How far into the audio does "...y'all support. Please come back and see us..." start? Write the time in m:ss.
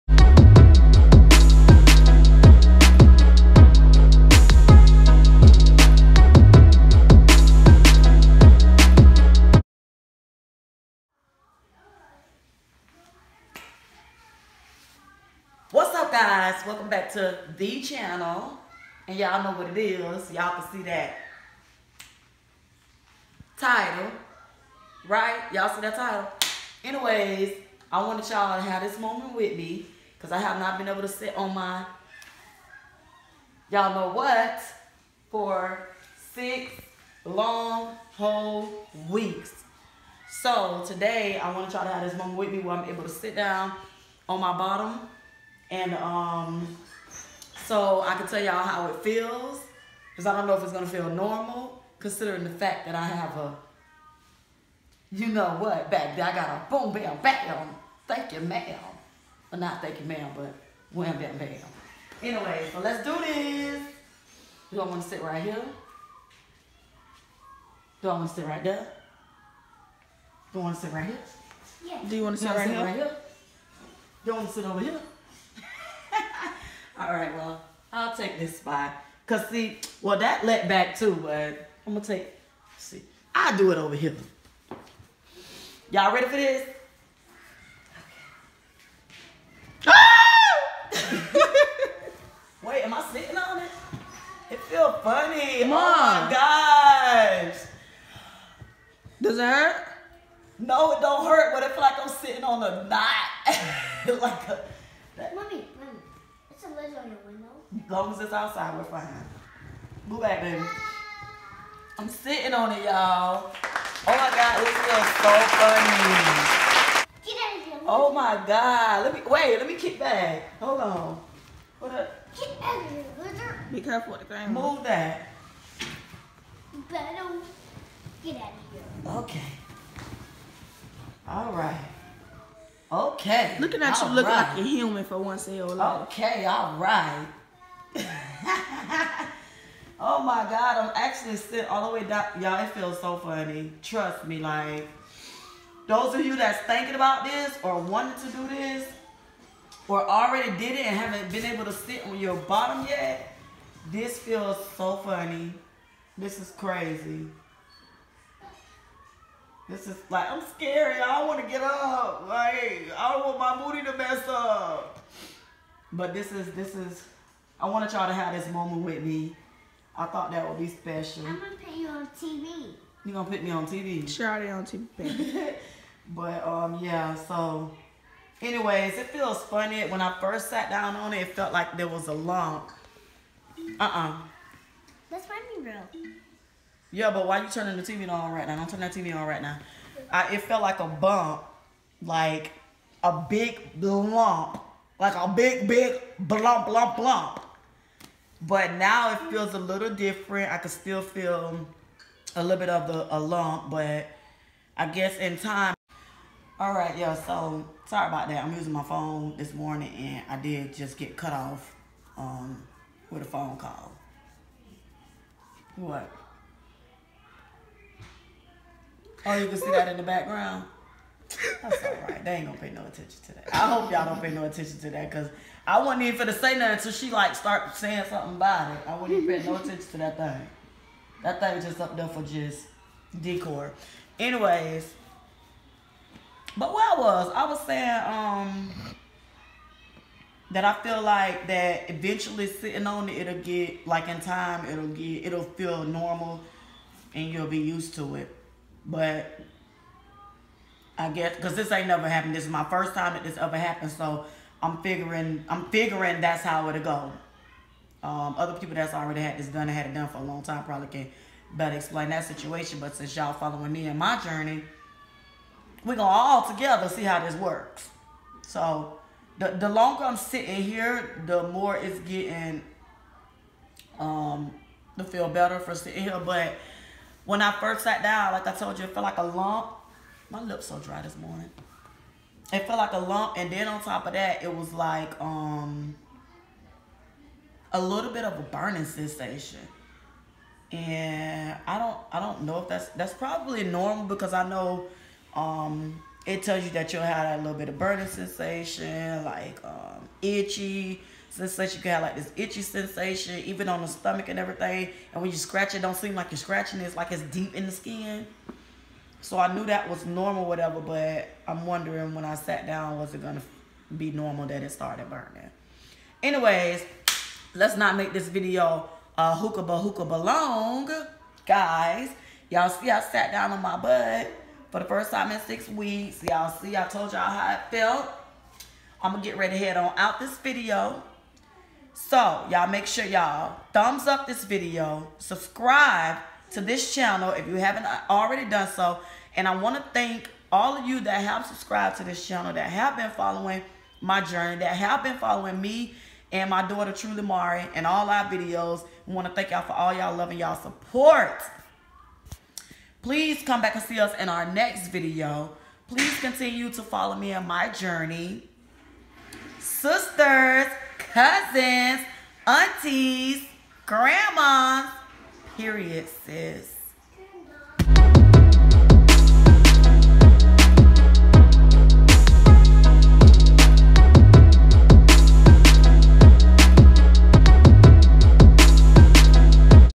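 5:50.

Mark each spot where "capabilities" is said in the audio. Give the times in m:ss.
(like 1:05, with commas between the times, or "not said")
not said.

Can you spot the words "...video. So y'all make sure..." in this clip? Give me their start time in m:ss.
5:30.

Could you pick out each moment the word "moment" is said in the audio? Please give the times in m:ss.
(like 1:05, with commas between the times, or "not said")
0:28, 0:42, 2:48.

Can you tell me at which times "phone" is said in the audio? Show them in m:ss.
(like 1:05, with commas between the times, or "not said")
3:28, 3:33.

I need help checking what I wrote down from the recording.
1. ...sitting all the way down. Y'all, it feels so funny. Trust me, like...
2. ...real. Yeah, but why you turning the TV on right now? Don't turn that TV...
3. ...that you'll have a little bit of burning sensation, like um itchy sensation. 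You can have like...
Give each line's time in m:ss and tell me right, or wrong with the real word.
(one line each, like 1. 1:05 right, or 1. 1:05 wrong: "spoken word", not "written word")
1. 2:21 right
2. 3:05 right
3. 4:56 right.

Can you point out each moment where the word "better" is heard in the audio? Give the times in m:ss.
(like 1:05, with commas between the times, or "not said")
2:06, 4:21, 4:35.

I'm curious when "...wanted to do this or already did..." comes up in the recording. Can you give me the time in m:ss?
2:27.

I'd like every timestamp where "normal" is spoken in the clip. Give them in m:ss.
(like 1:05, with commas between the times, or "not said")
0:51, 4:05, 4:53, 5:10, 5:14.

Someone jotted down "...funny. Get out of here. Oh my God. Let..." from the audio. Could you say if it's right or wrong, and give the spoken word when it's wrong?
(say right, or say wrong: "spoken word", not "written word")
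right.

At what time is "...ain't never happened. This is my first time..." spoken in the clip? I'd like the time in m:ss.
4:11.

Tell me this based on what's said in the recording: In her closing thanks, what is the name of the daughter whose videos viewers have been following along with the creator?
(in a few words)
Truly Mari.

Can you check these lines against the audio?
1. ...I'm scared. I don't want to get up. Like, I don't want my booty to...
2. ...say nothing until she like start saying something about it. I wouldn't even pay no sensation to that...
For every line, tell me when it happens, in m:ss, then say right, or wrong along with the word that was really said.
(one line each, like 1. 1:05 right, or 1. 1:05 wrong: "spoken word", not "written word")
1. 2:40 right
2. 3:46 wrong: "attention", not "sensation".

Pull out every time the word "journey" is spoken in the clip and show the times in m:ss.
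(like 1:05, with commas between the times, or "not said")
4:24, 5:44, 5:57.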